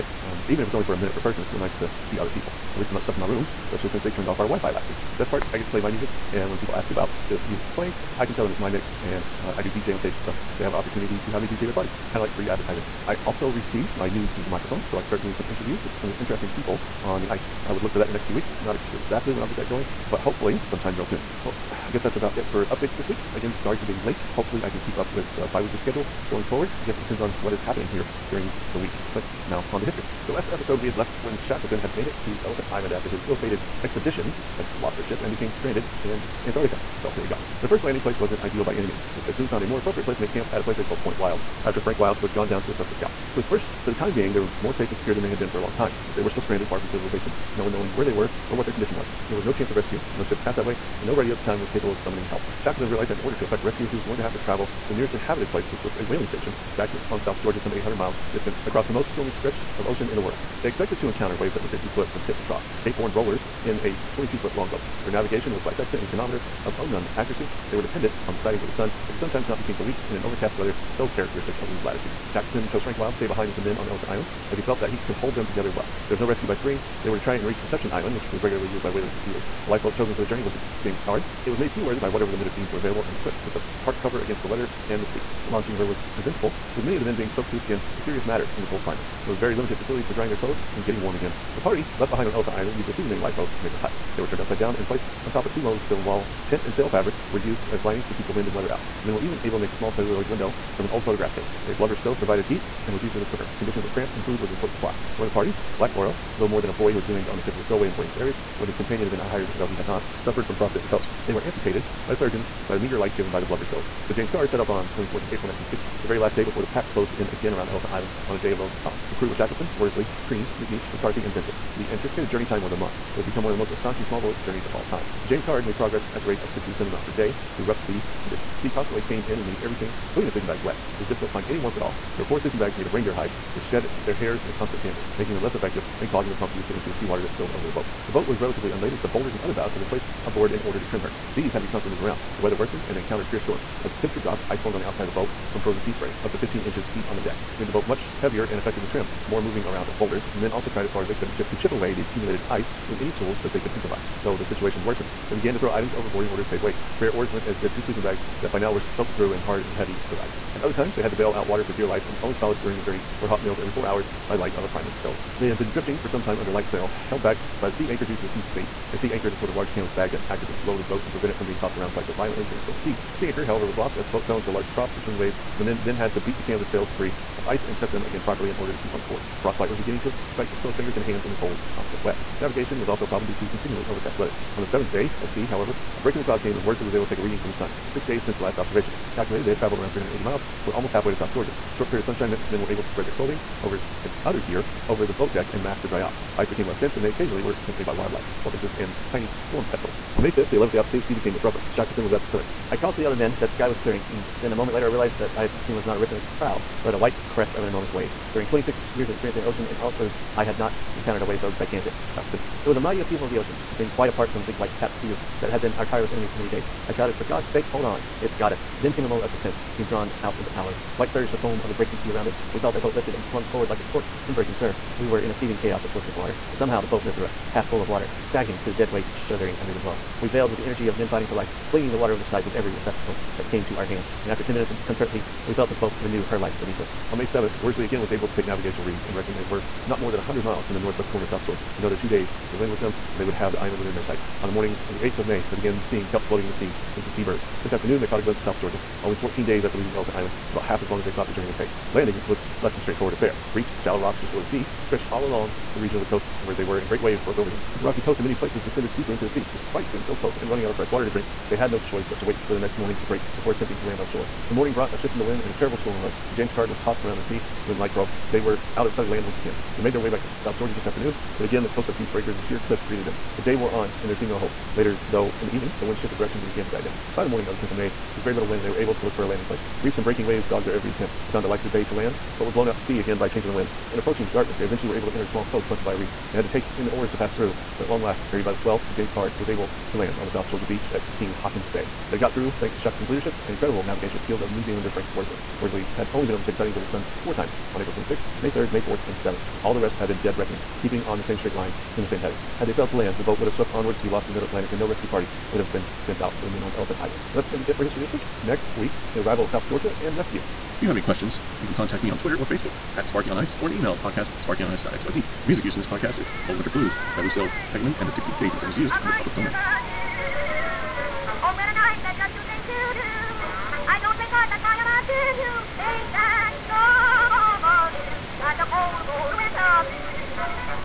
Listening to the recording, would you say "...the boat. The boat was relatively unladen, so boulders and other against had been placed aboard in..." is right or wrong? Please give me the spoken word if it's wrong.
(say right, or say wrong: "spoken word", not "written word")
wrong: "ballast", not "against".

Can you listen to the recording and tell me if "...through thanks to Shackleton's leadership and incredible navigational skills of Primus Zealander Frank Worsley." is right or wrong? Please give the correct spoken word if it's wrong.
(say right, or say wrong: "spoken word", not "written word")
wrong: "New", not "Primus".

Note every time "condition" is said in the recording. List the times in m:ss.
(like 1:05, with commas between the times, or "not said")
0:48, 1:43, 2:08.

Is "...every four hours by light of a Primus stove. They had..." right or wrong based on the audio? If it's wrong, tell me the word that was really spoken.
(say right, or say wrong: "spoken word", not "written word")
right.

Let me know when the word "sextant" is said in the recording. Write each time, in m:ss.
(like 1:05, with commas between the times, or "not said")
1:05.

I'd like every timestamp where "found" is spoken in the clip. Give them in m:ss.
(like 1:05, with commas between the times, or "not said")
0:39, 4:41.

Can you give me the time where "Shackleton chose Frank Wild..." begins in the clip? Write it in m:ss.
1:12.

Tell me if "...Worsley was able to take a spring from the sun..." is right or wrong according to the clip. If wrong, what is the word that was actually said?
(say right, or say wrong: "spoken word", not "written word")
wrong: "reading", not "spring".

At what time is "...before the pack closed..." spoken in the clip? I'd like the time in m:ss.
1:56.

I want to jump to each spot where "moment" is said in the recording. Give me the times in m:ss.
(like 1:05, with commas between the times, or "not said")
3:24, 3:39.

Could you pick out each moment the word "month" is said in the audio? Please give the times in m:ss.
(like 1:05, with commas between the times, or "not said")
2:02.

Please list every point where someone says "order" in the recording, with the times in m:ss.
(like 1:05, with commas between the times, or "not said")
0:53, 2:20, 2:36, 2:58.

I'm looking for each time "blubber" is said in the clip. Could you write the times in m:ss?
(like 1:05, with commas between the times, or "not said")
1:41, 1:53.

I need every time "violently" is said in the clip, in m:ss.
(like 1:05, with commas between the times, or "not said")
2:52.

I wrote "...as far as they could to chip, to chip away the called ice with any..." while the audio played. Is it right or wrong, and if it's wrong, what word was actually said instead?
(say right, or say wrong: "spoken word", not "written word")
wrong: "accumulated", not "called".